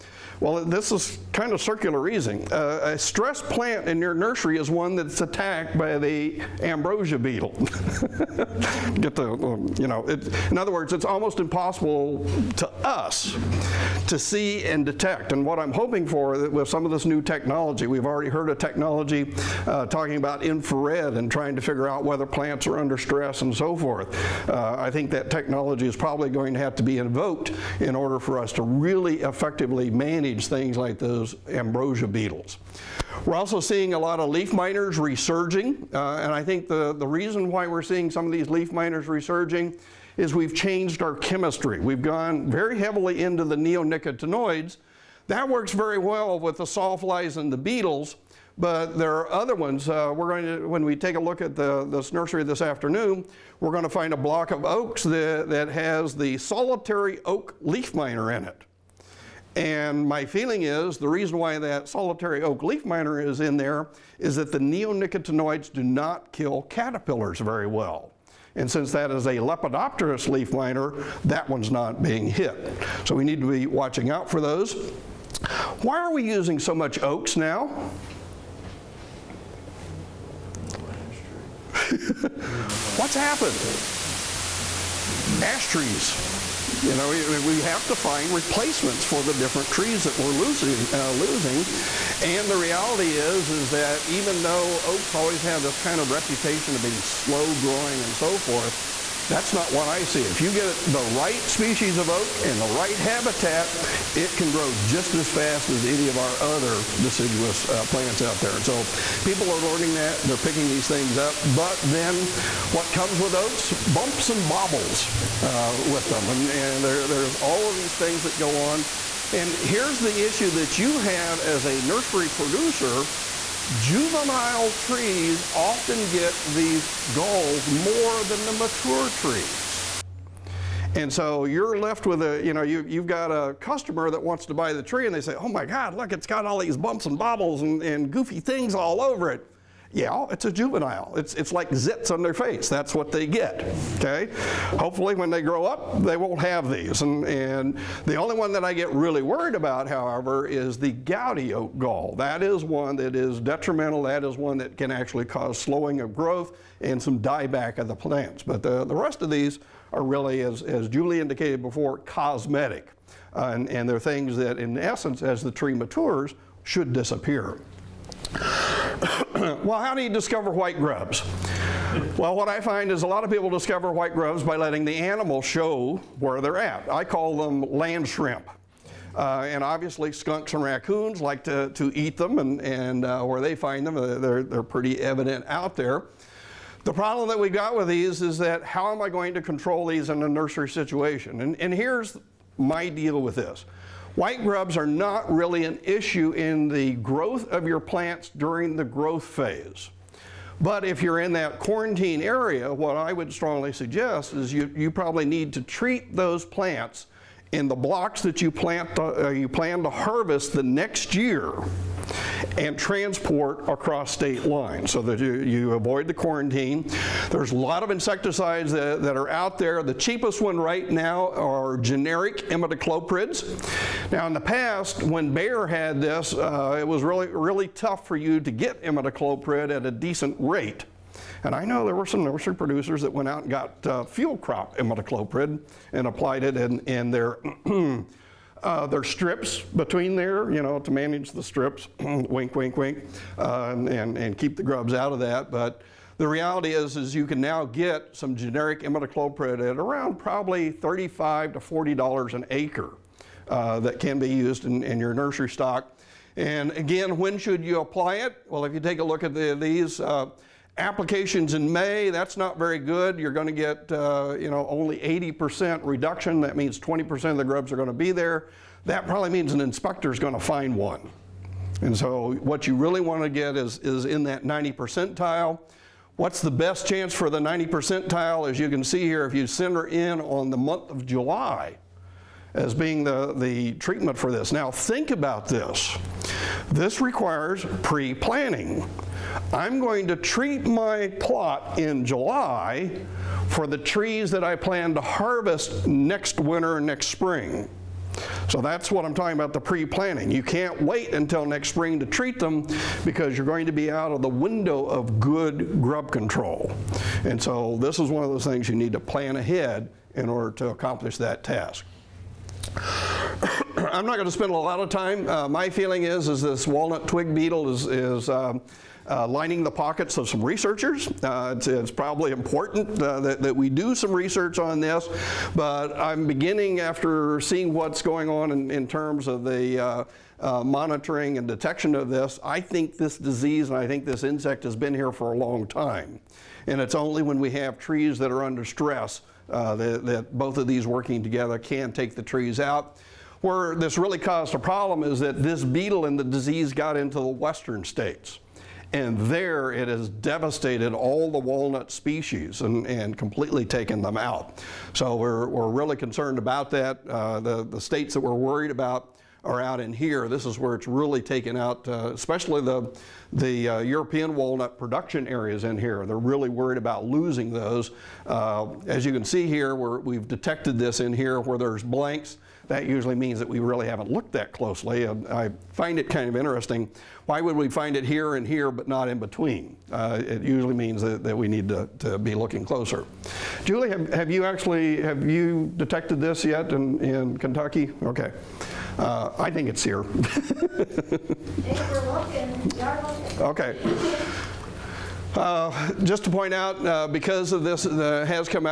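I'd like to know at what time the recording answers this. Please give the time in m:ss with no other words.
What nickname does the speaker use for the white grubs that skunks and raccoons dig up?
2:57.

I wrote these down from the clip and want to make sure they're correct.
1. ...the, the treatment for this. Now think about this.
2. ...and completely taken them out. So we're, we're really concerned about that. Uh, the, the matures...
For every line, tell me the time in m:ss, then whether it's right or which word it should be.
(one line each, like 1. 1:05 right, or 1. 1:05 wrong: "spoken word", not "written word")
1. 4:43 right
2. 5:52 wrong: "states", not "matures".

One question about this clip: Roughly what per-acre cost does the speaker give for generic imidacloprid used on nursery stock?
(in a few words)
$35 to $40.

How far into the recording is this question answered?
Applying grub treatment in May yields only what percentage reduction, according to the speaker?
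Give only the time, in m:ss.
4:24.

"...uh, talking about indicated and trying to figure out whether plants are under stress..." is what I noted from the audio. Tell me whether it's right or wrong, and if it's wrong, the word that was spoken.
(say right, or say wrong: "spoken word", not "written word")
wrong: "infrared", not "indicated".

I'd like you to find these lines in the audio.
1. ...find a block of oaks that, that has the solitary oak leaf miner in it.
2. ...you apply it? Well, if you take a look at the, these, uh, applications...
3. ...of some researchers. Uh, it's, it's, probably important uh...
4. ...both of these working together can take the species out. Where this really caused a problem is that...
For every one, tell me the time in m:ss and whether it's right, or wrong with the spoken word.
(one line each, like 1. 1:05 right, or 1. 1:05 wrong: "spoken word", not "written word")
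1. 0:53 right
2. 4:17 right
3. 5:20 right
4. 5:40 wrong: "trees", not "species".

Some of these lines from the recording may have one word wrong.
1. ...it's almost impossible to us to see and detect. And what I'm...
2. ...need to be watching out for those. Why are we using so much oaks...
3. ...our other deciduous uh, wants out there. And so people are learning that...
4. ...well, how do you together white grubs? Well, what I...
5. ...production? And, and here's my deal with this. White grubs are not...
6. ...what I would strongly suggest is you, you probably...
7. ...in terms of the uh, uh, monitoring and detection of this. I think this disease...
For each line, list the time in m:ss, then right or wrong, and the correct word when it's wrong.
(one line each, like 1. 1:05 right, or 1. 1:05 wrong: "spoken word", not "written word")
1. 0:10 right
2. 1:13 right
3. 1:46 wrong: "plants", not "wants"
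4. 2:49 wrong: "discover", not "together"
5. 3:10 wrong: "situation", not "production"
6. 3:22 right
7. 5:28 right.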